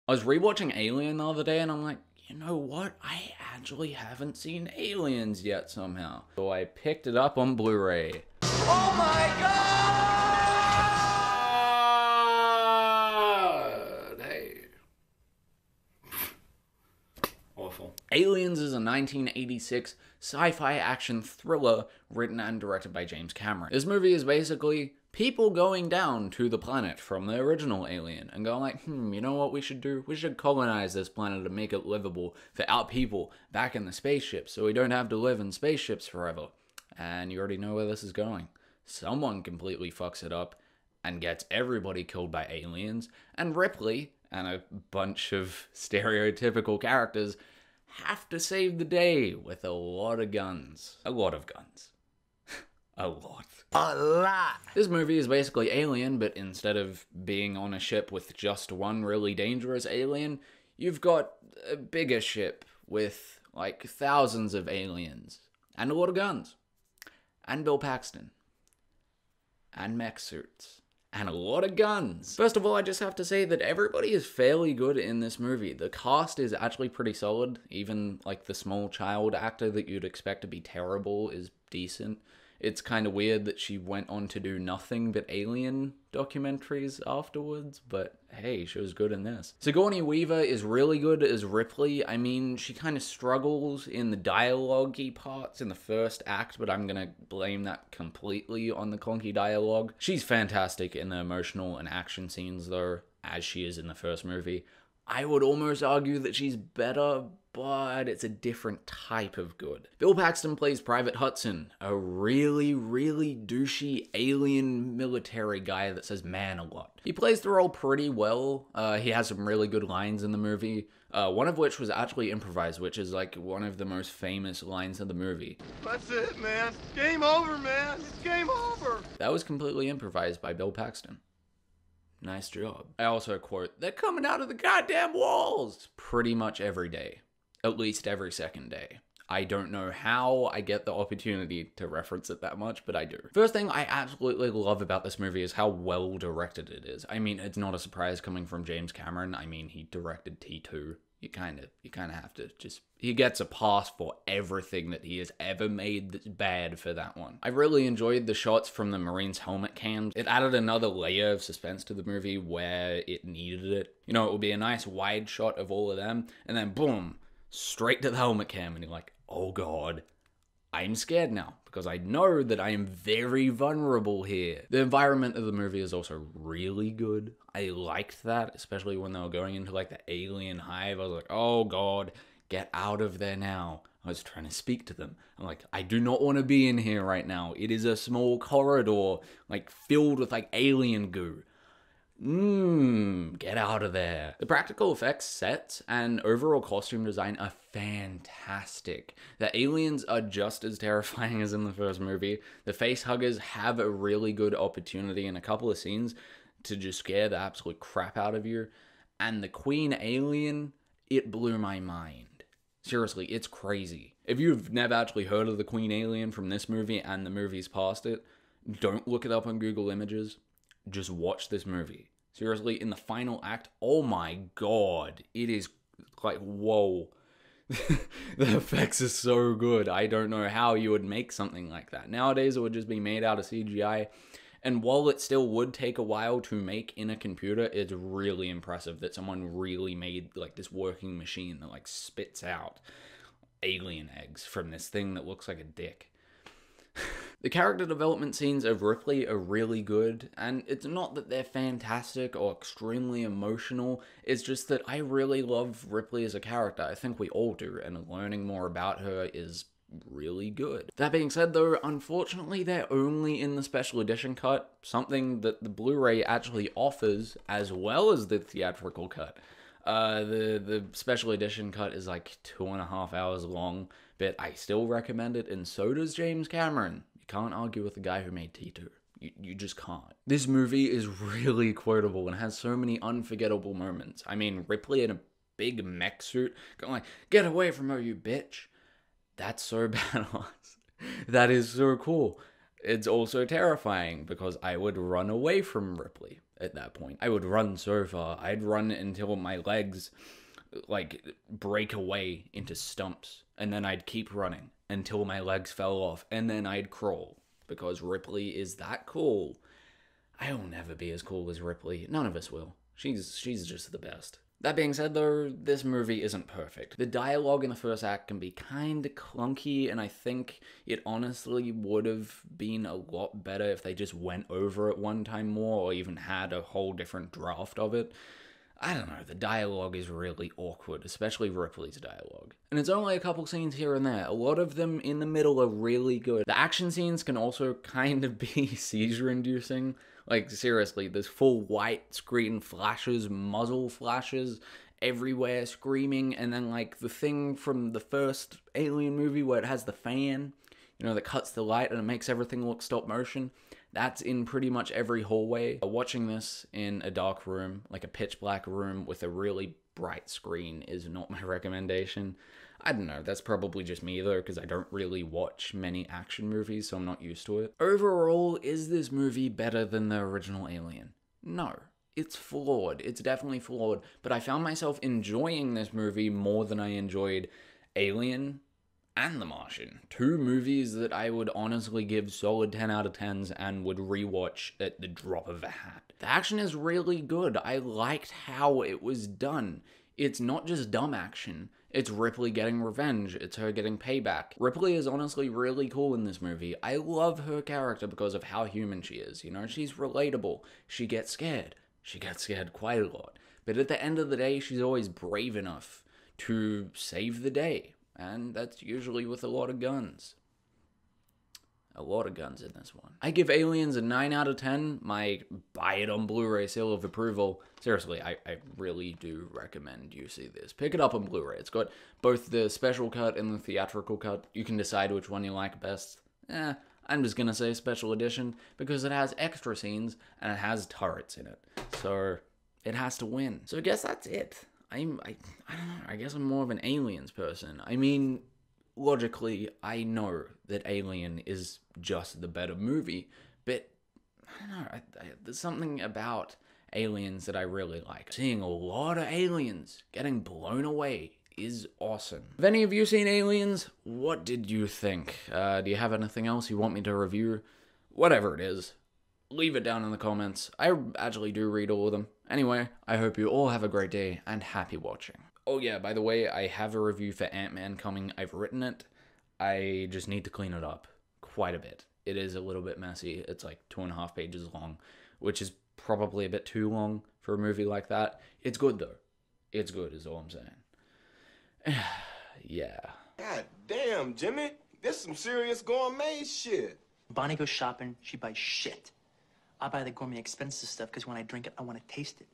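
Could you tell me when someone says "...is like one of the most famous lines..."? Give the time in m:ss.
2:02.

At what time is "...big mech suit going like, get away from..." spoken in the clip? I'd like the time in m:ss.
4:45.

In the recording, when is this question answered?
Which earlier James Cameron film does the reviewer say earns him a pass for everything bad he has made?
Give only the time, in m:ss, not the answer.
2:29.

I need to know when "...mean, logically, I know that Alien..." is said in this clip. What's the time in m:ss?
7:17.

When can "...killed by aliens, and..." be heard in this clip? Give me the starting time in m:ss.
0:42.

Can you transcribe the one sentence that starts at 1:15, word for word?
The cast is actually pretty solid.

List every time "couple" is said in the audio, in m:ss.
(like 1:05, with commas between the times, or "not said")
3:25, 5:33.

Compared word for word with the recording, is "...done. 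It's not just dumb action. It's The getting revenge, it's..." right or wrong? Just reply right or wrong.
wrong.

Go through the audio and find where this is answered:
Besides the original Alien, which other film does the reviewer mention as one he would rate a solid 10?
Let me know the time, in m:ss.
6:19.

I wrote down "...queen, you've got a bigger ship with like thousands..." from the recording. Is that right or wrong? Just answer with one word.
wrong.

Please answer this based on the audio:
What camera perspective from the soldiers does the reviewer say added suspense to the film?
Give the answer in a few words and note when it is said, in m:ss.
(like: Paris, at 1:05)
helmet cams, at 2:39.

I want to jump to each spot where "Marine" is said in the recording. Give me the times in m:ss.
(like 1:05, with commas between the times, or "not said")
2:38.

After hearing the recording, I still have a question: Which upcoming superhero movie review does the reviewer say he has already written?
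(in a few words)
Ant-Man.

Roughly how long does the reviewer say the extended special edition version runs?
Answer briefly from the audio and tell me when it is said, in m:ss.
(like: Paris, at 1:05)
two and a half hours, at 4:32.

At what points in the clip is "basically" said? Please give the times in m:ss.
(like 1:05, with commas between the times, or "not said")
0:24, 0:55.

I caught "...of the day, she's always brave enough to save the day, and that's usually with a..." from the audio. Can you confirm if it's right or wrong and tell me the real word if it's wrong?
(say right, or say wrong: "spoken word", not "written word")
right.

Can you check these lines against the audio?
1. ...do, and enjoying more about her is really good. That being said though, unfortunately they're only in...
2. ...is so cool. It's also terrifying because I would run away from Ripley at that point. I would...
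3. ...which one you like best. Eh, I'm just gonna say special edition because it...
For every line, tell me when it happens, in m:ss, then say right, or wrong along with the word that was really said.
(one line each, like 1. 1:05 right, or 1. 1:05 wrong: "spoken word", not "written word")
1. 4:17 wrong: "learning", not "enjoying"
2. 4:51 right
3. 7:05 right.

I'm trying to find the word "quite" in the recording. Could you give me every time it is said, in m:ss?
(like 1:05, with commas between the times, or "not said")
6:42, 7:51.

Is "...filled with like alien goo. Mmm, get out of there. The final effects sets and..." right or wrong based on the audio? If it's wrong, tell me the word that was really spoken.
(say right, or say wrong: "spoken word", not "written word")
wrong: "practical", not "final".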